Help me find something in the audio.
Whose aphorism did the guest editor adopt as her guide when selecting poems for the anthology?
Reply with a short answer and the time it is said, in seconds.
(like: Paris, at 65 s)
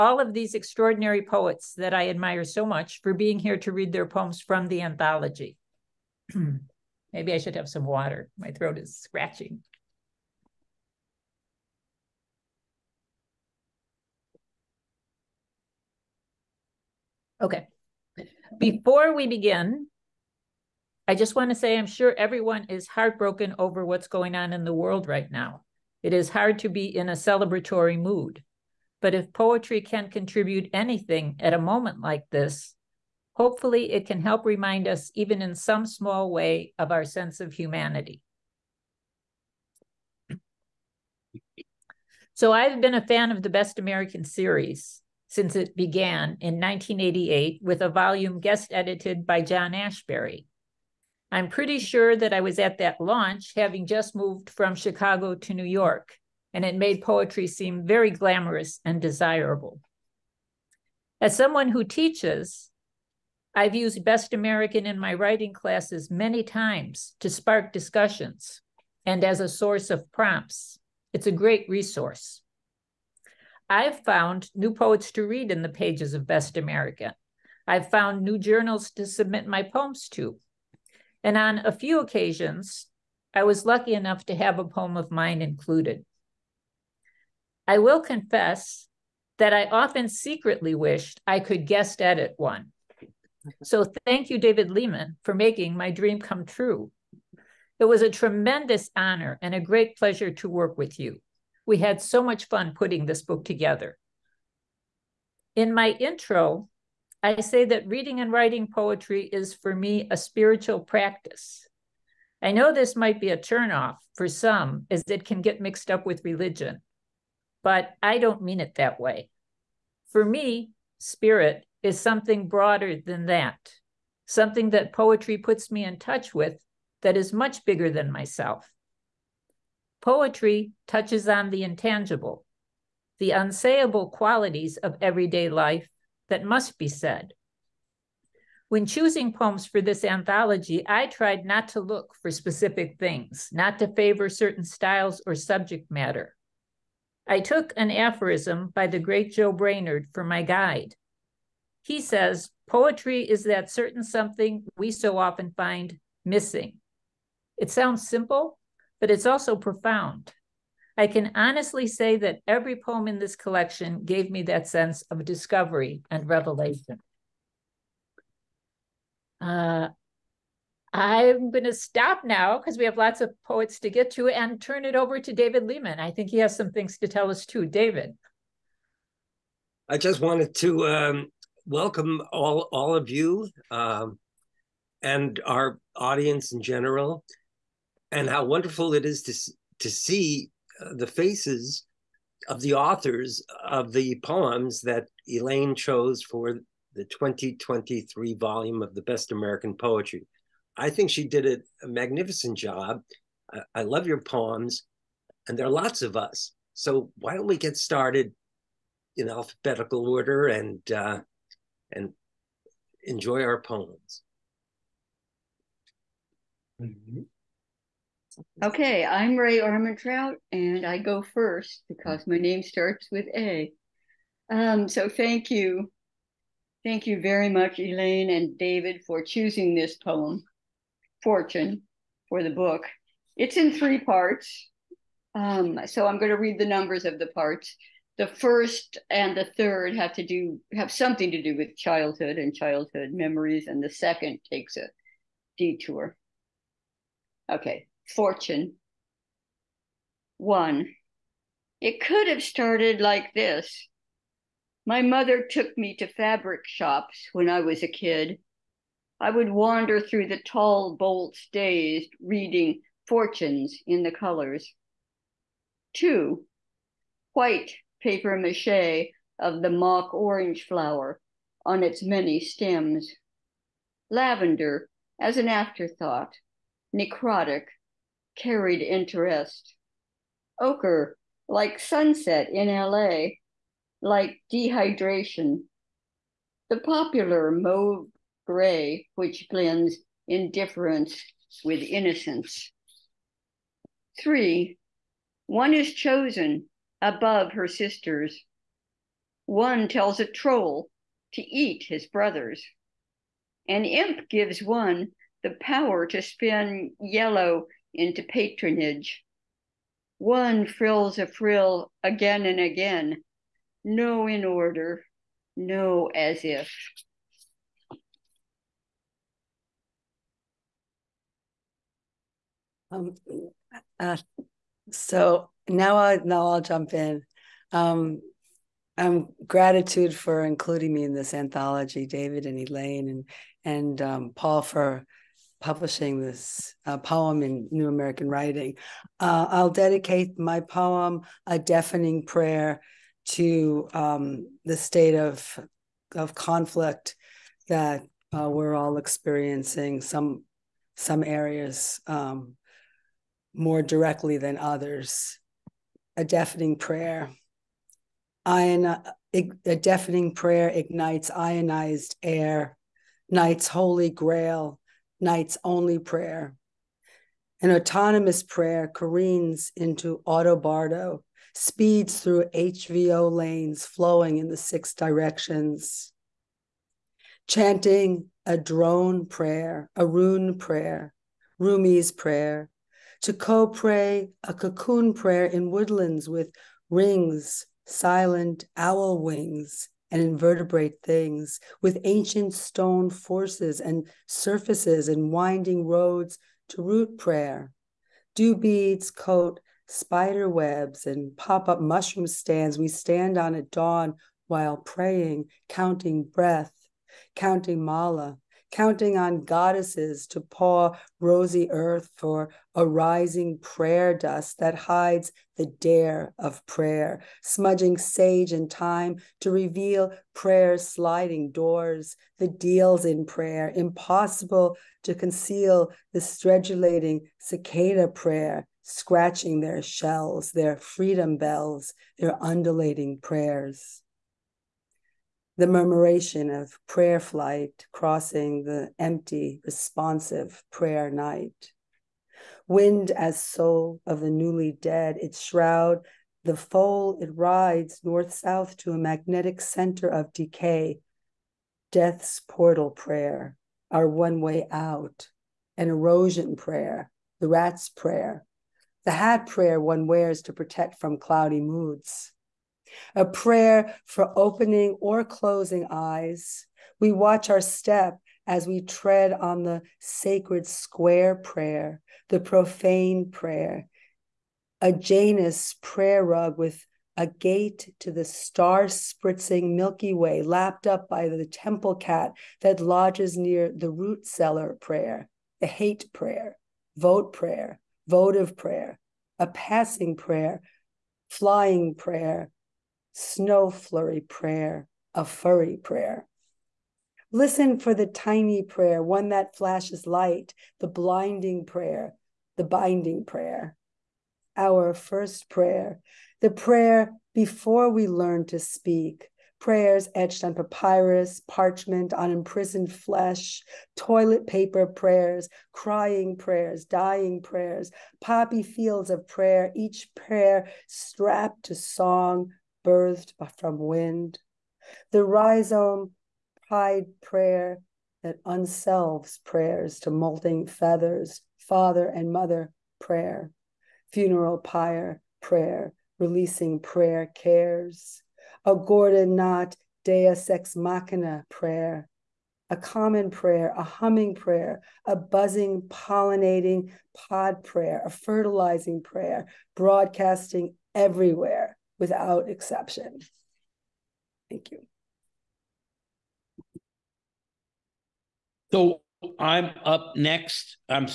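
Joe Brainard, at 149 s.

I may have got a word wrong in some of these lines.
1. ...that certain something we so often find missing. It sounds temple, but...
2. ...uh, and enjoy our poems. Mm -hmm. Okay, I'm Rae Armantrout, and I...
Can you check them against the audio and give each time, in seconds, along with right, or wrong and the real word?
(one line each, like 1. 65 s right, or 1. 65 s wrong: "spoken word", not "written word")
1. 153 s wrong: "simple", not "temple"
2. 210 s right.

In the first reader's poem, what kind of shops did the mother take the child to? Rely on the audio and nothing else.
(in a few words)
Fabric shops.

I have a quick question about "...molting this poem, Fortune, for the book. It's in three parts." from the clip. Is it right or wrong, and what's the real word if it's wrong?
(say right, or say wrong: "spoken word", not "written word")
wrong: "choosing", not "molting".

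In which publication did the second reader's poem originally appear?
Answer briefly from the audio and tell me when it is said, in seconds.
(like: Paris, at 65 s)
New American Writing, at 337 s.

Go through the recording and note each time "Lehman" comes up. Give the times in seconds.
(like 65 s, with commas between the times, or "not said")
94 s, 175 s.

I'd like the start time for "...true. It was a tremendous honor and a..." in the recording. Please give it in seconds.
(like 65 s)
96 s.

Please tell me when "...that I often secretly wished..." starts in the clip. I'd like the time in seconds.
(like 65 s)
89 s.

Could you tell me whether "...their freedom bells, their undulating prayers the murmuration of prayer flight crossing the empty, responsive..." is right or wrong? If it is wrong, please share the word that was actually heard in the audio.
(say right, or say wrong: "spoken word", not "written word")
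right.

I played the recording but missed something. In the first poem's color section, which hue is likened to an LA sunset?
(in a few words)
Ochre.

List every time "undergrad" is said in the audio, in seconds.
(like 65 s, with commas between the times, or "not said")
not said.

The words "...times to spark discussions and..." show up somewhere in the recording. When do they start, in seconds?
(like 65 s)
66 s.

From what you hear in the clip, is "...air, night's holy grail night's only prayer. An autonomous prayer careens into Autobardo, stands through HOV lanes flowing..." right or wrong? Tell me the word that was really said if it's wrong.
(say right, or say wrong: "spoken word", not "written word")
wrong: "speeds", not "stands".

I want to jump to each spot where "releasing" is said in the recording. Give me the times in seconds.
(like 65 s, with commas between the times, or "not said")
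536 s.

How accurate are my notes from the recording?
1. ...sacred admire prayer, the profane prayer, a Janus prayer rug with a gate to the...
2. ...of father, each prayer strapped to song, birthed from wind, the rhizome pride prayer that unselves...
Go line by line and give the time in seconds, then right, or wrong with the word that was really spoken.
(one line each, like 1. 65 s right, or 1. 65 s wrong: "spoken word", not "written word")
1. 469 s wrong: "square", not "admire"
2. 519 s wrong: "prayer", not "father".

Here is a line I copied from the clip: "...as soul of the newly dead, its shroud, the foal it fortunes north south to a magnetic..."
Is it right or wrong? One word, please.
wrong.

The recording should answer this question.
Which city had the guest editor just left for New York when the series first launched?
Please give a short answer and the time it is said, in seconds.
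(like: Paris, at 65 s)
Chicago, at 54 s.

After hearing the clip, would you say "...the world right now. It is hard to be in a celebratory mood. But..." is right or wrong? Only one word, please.
right.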